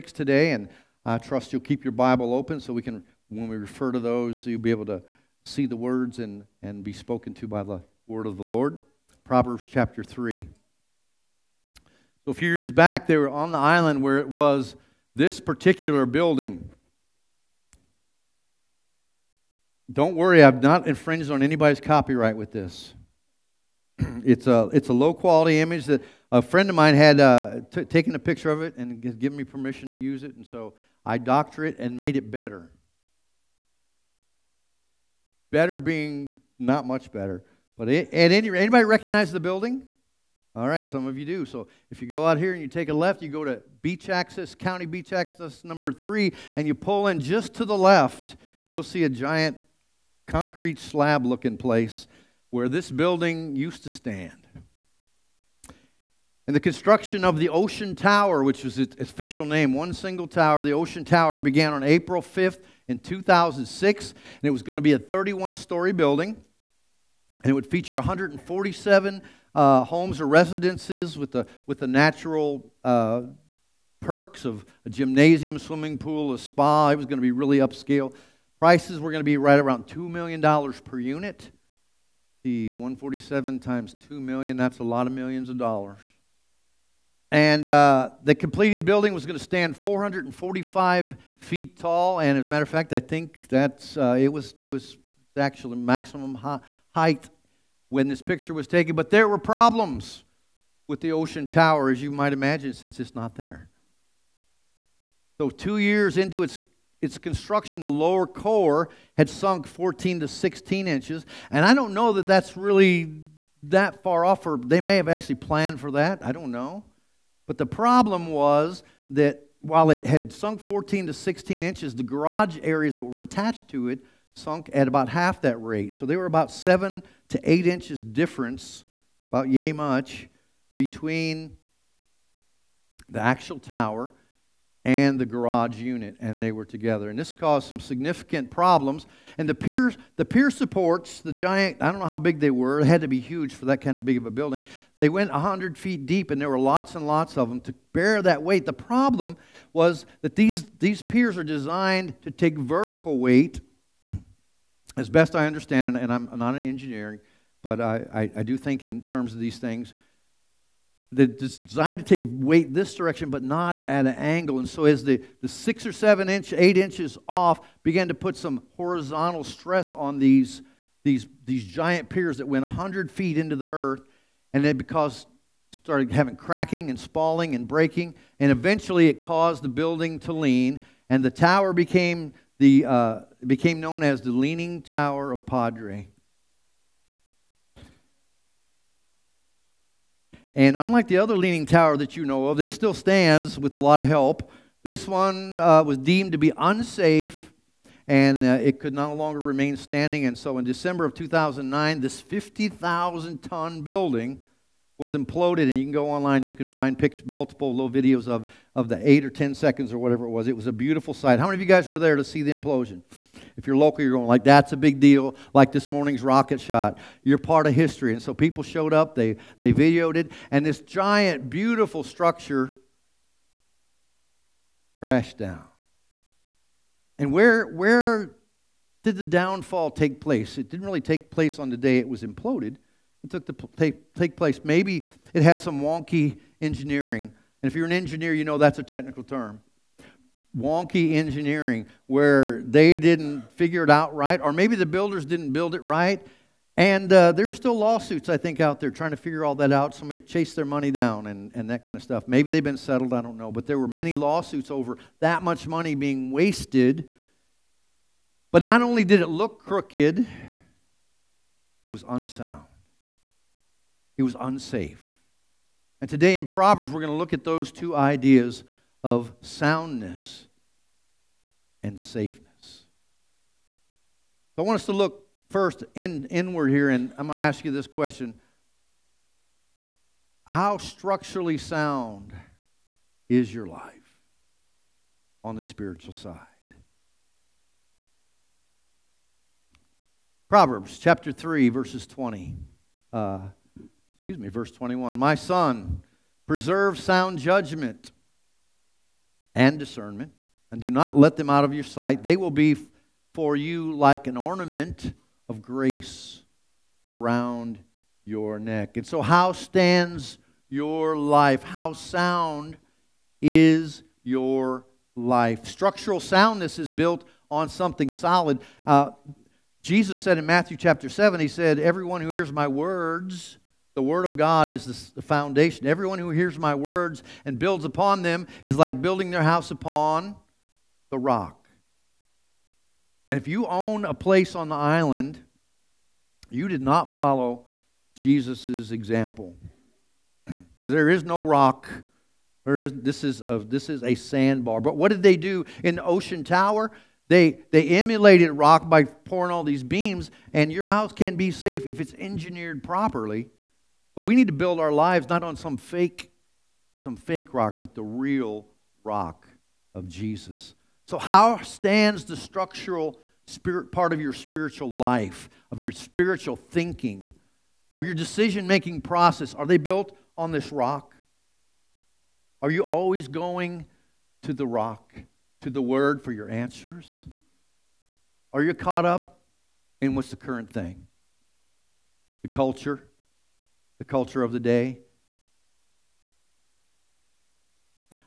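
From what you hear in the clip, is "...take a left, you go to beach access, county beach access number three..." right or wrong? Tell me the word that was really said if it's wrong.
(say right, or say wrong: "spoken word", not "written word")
right.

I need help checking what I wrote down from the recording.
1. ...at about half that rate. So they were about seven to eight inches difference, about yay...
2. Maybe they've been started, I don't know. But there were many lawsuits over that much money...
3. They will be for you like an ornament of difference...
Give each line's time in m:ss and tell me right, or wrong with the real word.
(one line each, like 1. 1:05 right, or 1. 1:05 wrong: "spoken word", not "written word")
1. 2:04 right
2. 4:12 wrong: "settled", not "started"
3. 5:02 wrong: "grace", not "difference".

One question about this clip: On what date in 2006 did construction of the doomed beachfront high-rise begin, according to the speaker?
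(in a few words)
April 5th.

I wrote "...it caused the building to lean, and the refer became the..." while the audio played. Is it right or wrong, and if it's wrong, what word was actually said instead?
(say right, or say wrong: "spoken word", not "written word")
wrong: "tower", not "refer".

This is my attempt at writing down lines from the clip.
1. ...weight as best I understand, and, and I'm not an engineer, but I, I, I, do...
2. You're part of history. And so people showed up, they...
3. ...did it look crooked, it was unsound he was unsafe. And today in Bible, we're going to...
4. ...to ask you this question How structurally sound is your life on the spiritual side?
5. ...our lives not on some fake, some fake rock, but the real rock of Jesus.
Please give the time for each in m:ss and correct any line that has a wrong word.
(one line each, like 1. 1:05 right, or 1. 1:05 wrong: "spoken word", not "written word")
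1. 2:33 right
2. 3:37 right
3. 4:19 wrong: "Proverbs", not "Bible"
4. 4:37 right
5. 5:54 right.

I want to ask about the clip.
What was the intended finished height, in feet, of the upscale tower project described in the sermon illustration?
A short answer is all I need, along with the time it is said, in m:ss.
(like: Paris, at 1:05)
445 feet, at 1:29.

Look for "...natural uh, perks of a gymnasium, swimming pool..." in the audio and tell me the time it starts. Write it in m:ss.
1:11.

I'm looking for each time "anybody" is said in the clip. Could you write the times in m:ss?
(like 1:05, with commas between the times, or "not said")
0:21, 0:38.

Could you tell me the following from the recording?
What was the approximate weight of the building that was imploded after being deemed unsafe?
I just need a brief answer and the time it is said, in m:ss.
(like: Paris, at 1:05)
50,000 tons, at 3:22.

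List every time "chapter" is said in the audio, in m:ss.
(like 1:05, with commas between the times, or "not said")
0:09, 4:50, 5:20.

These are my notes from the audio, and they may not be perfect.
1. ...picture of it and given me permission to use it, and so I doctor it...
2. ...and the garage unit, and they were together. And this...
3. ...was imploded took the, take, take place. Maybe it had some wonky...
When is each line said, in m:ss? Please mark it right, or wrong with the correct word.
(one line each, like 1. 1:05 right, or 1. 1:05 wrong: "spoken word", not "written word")
1. 0:28 right
2. 2:14 right
3. 3:52 right.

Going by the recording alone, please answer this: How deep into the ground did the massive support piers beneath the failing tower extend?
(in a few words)
100 feet.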